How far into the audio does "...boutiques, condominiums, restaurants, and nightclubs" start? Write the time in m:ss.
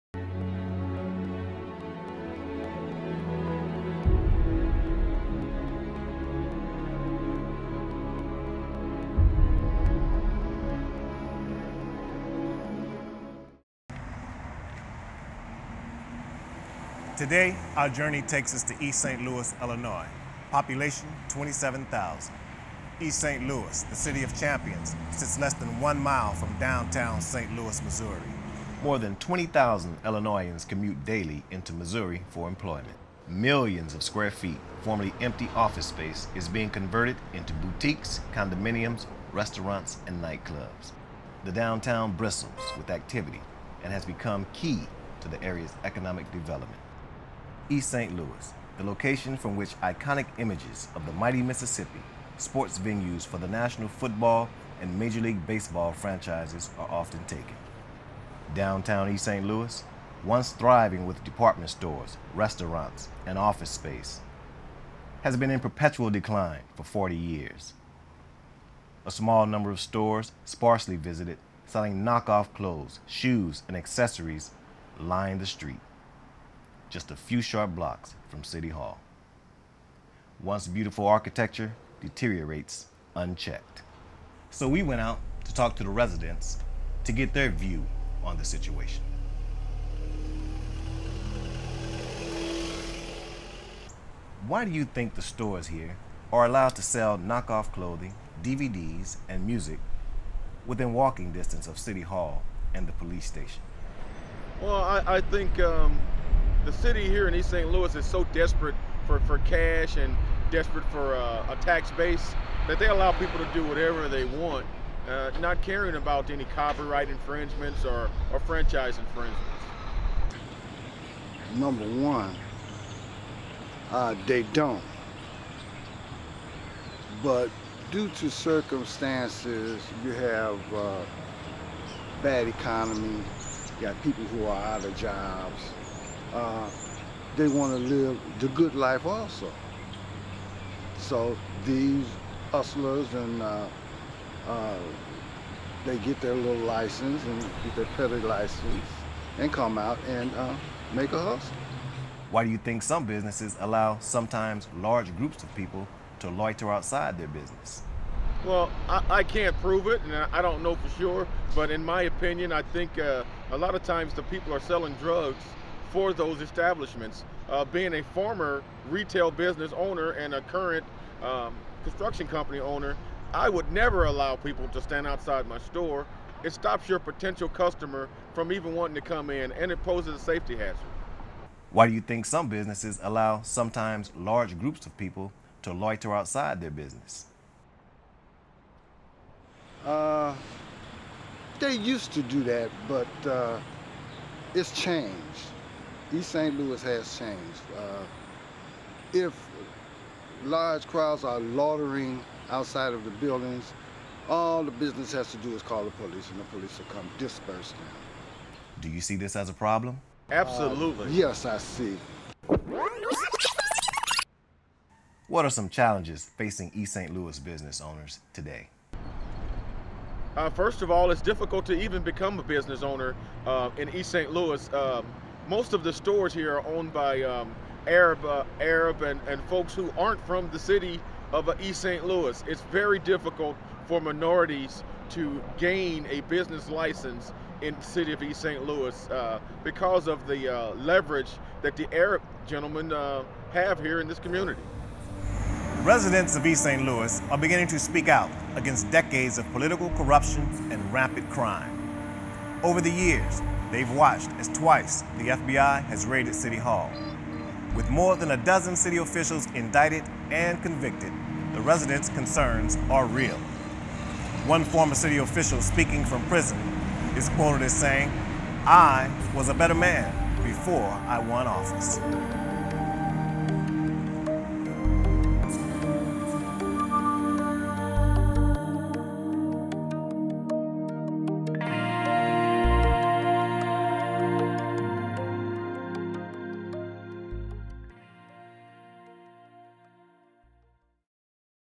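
0:37.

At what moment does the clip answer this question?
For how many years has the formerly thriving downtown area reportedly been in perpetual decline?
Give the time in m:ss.
1:06.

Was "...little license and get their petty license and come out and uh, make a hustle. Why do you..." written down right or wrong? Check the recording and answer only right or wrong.
right.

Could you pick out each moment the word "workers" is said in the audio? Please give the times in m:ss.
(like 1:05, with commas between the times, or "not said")
not said.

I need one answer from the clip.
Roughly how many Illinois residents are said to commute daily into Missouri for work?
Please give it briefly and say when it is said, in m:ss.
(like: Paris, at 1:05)
More than 20,000, at 0:28.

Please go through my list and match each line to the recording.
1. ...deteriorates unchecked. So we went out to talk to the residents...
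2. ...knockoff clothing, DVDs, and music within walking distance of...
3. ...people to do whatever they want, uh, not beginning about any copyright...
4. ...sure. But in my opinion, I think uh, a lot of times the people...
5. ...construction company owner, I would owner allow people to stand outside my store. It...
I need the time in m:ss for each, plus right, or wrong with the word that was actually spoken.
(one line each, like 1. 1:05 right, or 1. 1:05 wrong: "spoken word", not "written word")
1. 1:22 right
2. 1:37 right
3. 1:53 wrong: "caring", not "beginning"
4. 2:40 right
5. 2:51 wrong: "never", not "owner".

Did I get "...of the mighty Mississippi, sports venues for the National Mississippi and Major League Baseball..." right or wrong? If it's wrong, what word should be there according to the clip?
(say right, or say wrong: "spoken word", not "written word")
wrong: "Football", not "Mississippi".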